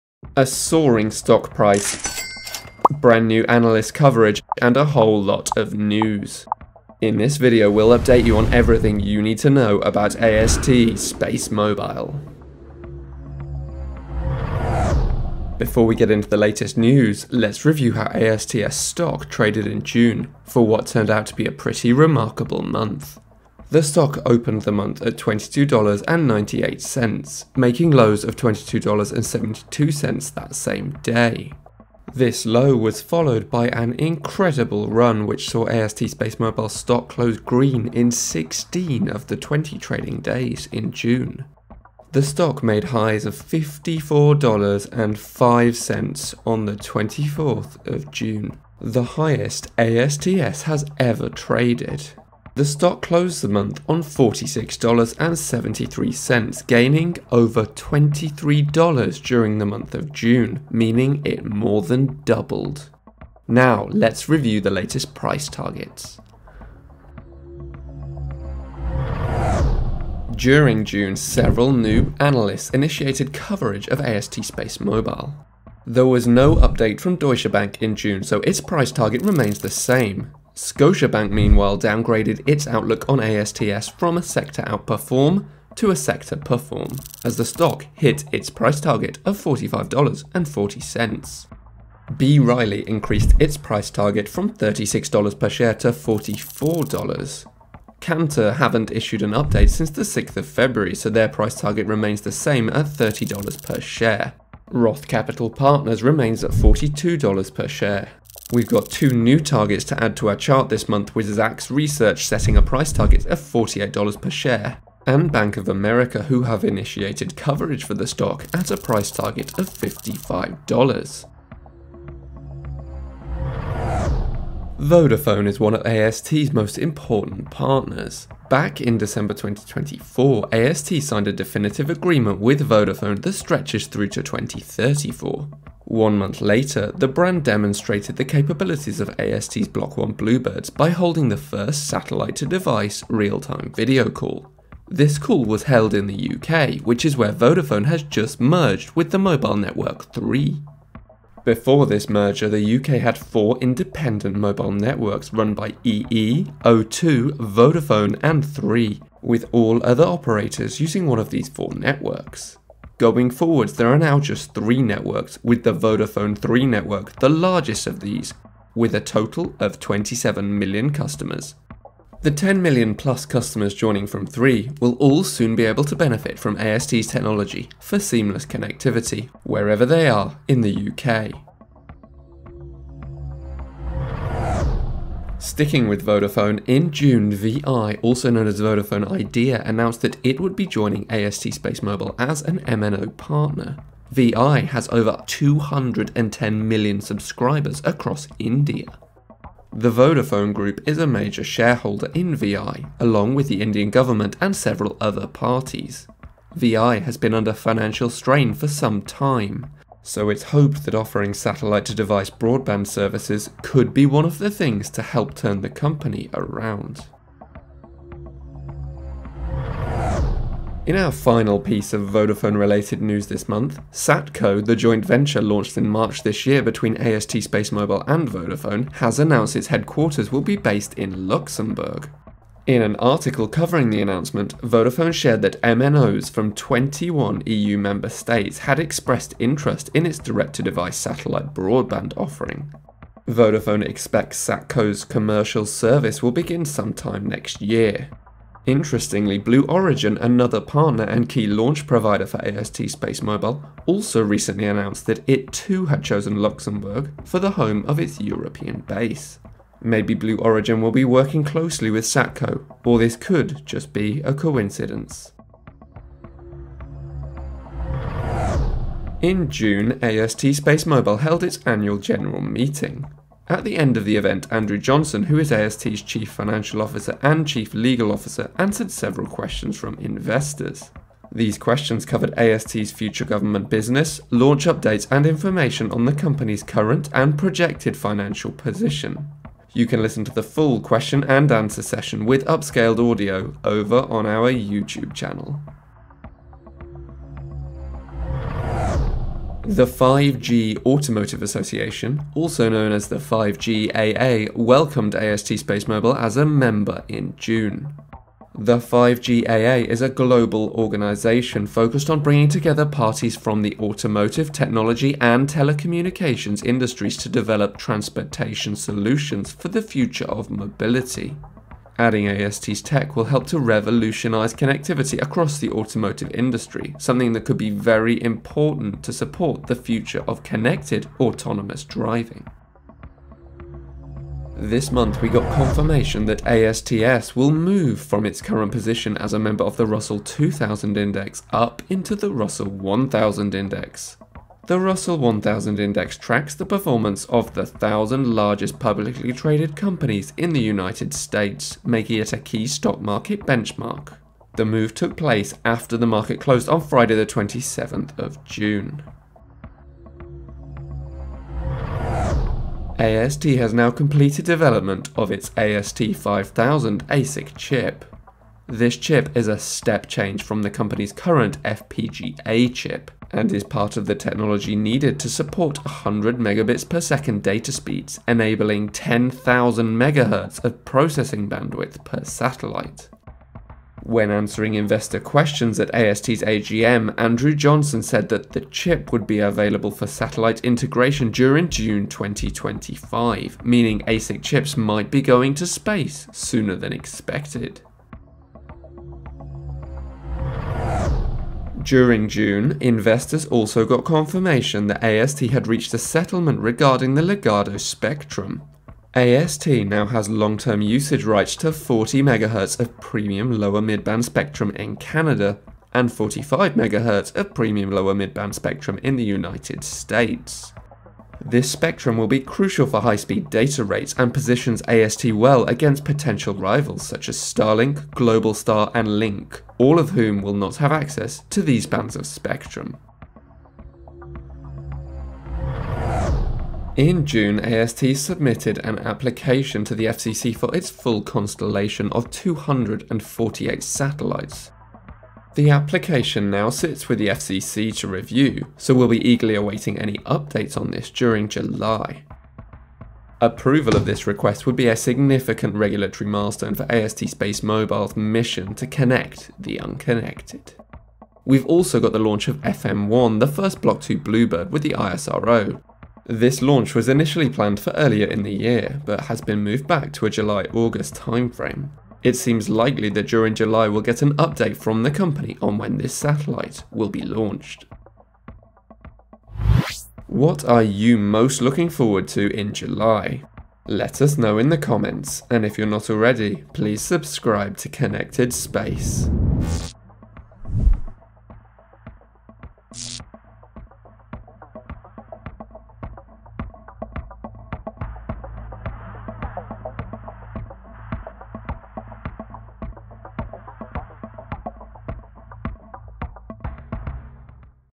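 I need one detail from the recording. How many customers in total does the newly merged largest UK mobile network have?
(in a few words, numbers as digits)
27 million.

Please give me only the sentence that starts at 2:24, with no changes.
This call was held in the UK, which is where Vodafone has just merged with the mobile network 3.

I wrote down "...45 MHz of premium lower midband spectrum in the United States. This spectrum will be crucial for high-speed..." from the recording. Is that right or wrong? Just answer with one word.
right.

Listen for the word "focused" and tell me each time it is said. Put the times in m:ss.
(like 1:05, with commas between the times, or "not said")
5:11.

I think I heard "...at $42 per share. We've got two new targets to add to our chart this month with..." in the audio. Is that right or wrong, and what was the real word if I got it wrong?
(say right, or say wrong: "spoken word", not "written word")
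right.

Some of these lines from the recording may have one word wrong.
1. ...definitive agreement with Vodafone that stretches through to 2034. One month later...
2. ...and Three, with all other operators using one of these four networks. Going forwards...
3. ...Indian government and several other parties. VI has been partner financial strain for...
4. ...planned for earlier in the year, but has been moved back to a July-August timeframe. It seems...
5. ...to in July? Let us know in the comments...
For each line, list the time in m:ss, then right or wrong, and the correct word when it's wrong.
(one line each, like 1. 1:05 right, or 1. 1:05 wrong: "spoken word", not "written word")
1. 2:11 right
2. 2:38 right
3. 3:23 wrong: "under", not "partner"
4. 7:47 right
5. 8:02 right.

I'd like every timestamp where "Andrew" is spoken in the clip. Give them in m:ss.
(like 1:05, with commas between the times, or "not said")
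4:34, 6:27.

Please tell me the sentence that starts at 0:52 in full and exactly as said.
The stock closed the month on $46.73, gaining over $23 during the month of June, meaning it more than doubled.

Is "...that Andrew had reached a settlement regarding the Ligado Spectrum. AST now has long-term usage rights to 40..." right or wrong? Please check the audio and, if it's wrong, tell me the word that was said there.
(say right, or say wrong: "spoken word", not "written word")
wrong: "AST", not "Andrew".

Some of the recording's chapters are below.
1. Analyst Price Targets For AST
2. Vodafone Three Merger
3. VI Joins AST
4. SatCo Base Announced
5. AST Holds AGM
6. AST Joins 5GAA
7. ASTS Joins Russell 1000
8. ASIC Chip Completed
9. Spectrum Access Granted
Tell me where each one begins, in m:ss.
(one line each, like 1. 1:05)
1. 1:08
2. 2:02
3. 3:03
4. 3:38
5. 4:27
6. 4:57
7. 5:34
8. 6:00
9. 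6:39.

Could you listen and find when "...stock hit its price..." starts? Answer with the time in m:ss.
1:27.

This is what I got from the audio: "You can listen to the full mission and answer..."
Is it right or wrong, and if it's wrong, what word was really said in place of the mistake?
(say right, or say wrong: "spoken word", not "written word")
wrong: "question", not "mission".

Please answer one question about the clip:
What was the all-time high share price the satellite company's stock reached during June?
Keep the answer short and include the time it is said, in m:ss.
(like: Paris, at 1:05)
$54.05, at 0:43.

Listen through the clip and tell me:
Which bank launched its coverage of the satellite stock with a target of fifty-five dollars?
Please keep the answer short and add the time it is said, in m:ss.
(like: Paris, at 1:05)
Bank of America, at 1:55.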